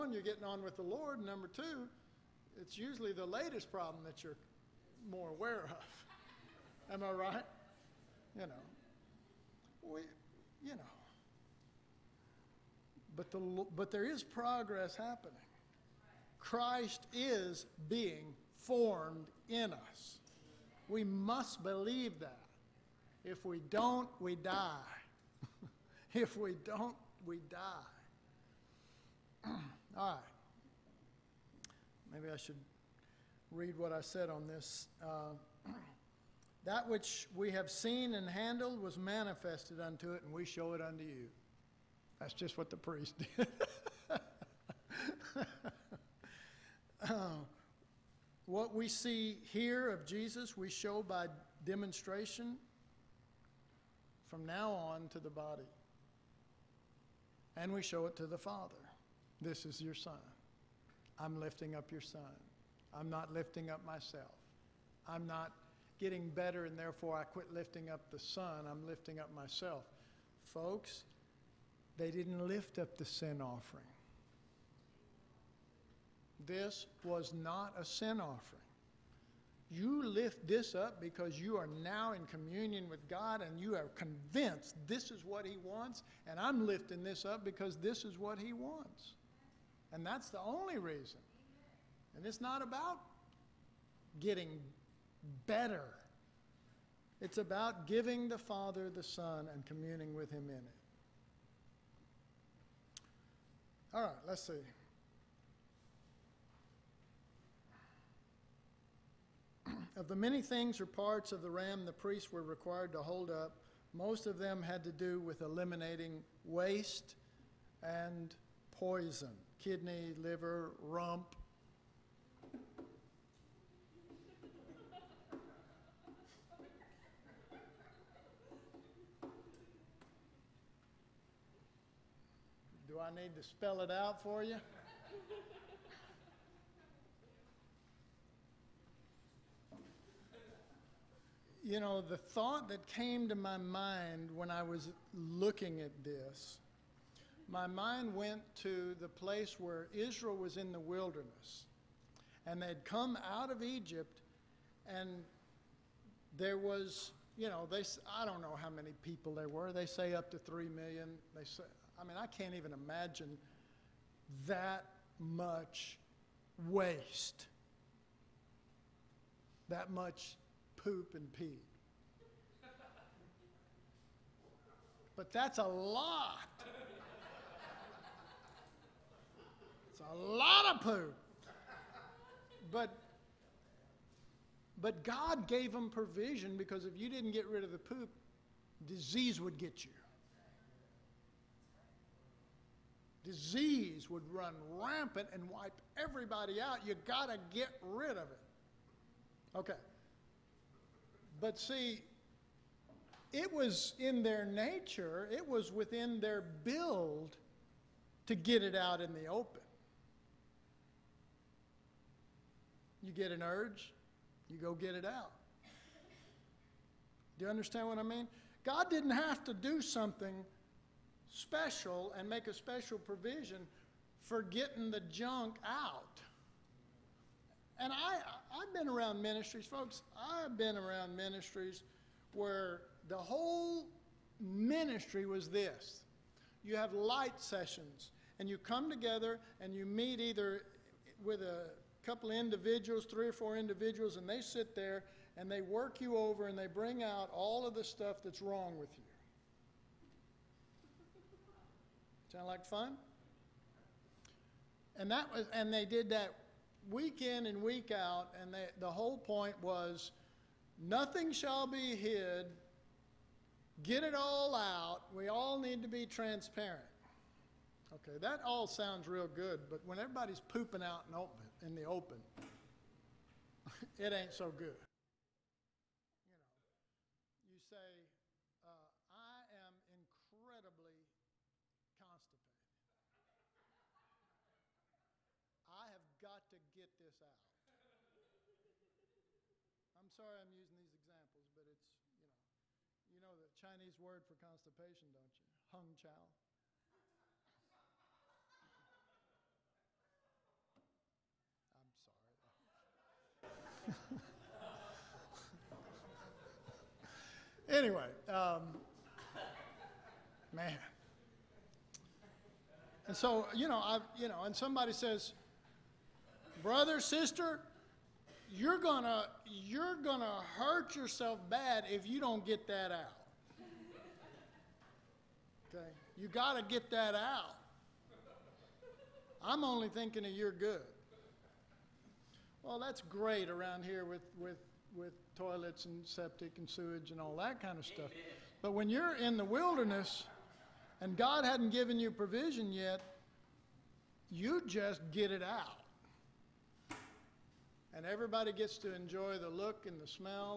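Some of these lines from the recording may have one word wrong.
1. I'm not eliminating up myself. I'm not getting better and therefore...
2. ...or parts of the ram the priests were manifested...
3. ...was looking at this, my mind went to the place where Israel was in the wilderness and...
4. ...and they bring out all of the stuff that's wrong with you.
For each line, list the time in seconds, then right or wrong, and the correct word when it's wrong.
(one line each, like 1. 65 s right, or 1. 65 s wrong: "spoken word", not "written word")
1. 62 s wrong: "lifting", not "eliminating"
2. 110 s wrong: "required", not "manifested"
3. 144 s right
4. 246 s right.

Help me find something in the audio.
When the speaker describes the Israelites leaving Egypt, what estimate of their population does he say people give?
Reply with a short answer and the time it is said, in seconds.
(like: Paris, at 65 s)
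3 million, at 160 s.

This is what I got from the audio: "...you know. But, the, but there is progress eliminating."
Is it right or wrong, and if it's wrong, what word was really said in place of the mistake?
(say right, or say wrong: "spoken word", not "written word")
wrong: "happening", not "eliminating".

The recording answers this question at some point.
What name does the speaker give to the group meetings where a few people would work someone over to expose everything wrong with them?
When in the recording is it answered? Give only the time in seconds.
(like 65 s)
236 s.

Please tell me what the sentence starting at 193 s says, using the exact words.
Disease would run rampant and wipe everybody out.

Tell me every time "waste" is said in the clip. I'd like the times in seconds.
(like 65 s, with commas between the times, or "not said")
116 s, 166 s.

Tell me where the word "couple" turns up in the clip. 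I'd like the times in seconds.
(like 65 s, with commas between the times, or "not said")
242 s.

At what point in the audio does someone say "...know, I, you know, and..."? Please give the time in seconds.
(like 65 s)
313 s.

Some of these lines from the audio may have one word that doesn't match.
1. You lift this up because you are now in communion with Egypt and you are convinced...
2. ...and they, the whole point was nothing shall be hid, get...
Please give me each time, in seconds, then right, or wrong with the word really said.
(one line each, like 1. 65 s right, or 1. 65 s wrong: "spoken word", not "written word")
1. 79 s wrong: "God", not "Egypt"
2. 258 s right.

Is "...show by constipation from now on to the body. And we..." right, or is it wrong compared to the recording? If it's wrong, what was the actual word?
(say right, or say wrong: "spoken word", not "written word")
wrong: "demonstration", not "constipation".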